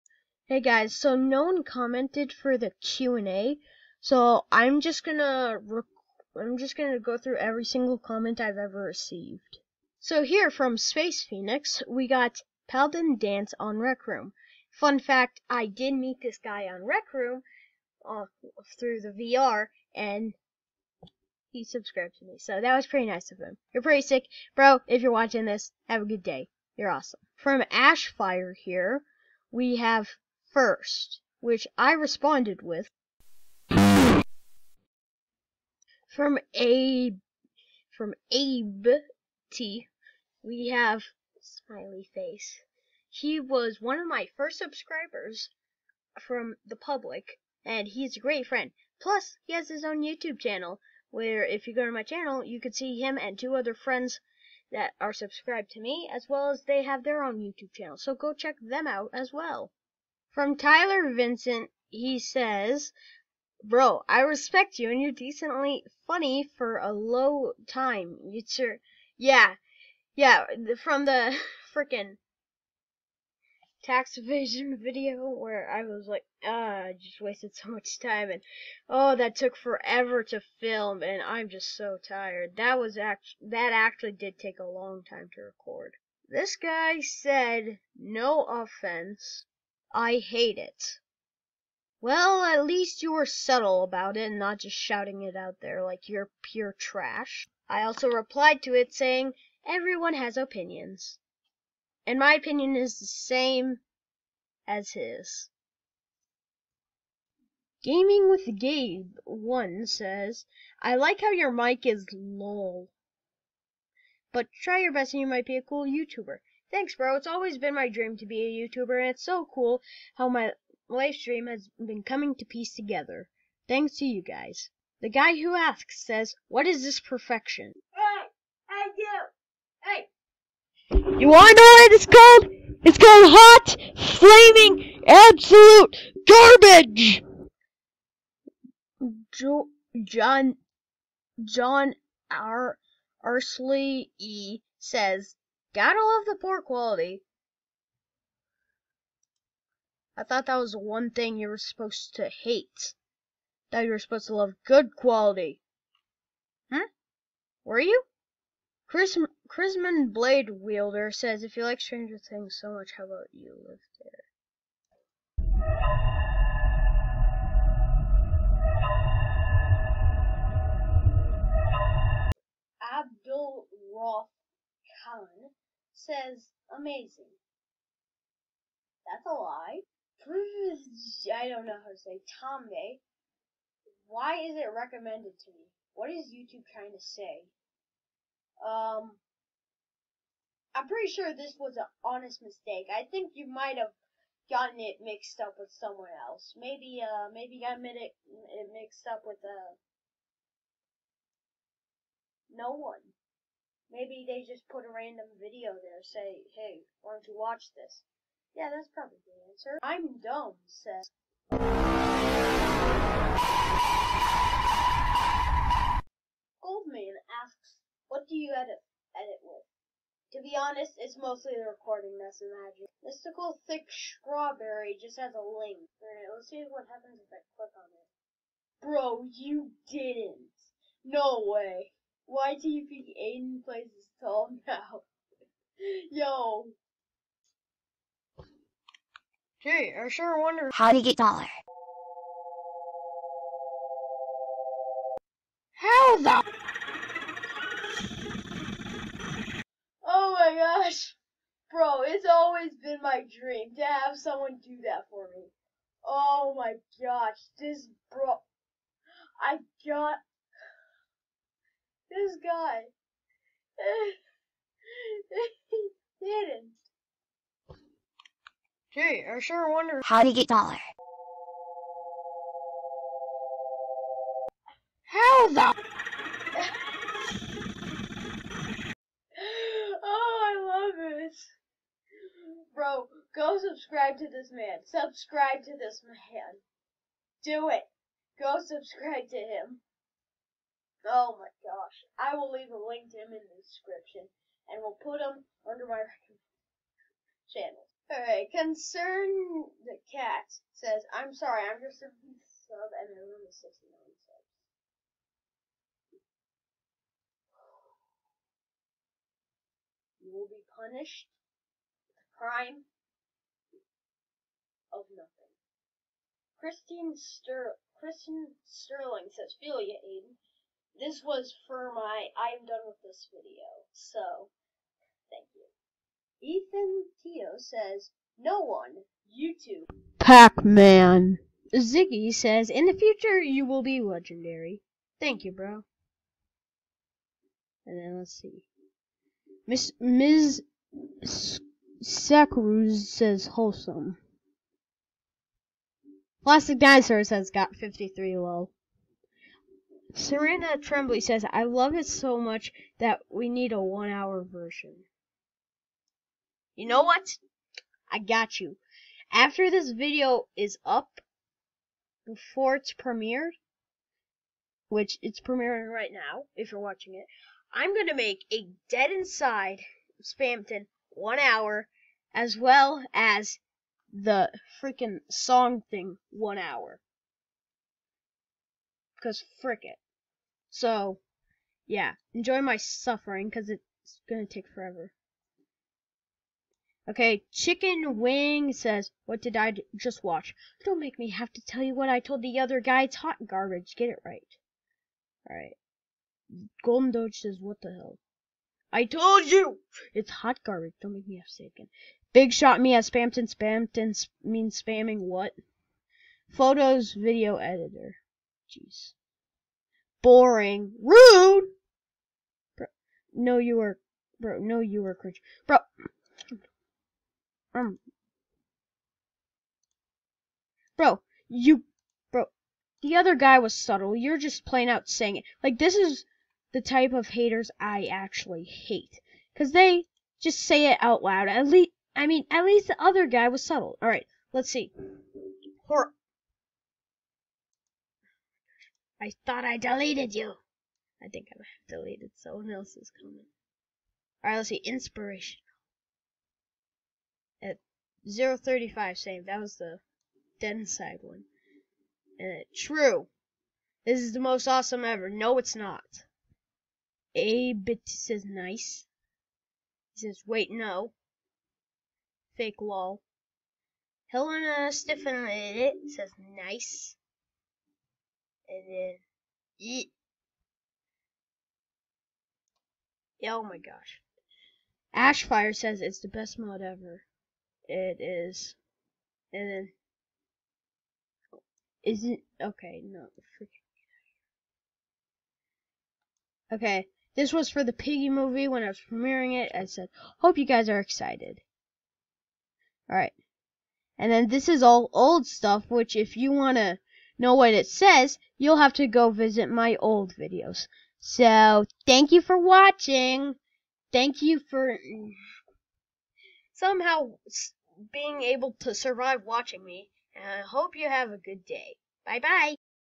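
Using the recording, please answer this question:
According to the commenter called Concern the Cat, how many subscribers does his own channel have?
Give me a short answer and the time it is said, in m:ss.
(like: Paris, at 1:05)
69, at 5:03.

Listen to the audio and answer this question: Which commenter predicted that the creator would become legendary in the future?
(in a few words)
Ziggy.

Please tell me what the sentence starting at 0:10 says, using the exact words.
So here from Space Phoenix, we got Paladin Dance on Rec Room.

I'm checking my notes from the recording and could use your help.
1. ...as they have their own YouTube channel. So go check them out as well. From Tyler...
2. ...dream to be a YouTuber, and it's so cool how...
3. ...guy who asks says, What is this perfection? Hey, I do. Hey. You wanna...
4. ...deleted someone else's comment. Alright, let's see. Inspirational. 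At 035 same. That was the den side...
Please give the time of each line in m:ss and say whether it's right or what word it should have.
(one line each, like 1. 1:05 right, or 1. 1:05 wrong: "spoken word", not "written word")
1. 0:56 right
2. 1:57 right
3. 2:05 right
4. 7:21 right.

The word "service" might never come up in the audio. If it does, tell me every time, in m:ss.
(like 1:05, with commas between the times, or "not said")
not said.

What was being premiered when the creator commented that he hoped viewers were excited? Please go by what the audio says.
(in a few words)
the Piggy movie.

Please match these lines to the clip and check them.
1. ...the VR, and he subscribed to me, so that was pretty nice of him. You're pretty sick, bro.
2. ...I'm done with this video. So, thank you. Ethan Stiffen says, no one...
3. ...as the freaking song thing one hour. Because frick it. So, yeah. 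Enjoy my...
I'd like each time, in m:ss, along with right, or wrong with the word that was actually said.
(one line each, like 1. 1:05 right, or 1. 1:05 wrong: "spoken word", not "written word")
1. 0:18 right
2. 5:22 wrong: "Teo", not "Stiffen"
3. 6:13 right.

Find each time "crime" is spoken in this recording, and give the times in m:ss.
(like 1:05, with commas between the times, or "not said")
5:12.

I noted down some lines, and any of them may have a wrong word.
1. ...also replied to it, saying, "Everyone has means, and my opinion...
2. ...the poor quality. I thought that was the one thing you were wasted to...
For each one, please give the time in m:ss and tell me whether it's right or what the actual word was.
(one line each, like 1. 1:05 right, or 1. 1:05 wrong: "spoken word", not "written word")
1. 1:37 wrong: "opinions", not "means"
2. 2:26 wrong: "supposed", not "wasted".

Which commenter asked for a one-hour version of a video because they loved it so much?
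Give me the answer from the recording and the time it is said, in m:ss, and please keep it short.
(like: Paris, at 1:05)
Serena Trembly, at 5:50.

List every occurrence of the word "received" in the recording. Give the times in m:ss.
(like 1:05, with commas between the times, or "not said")
0:08.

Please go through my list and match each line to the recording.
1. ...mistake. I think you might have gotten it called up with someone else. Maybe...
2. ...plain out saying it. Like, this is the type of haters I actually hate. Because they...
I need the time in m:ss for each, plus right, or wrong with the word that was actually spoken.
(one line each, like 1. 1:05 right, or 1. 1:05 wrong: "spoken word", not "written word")
1. 3:12 wrong: "mixed", not "called"
2. 7:04 right.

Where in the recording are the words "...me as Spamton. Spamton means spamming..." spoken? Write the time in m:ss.
6:42.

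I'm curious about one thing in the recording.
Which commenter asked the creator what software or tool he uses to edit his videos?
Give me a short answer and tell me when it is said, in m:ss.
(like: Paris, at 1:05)
Goldman, at 3:36.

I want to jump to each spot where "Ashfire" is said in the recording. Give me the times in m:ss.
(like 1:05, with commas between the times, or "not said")
0:27, 7:55.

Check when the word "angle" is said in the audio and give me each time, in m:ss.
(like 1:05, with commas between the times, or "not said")
not said.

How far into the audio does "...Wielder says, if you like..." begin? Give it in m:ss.
2:40.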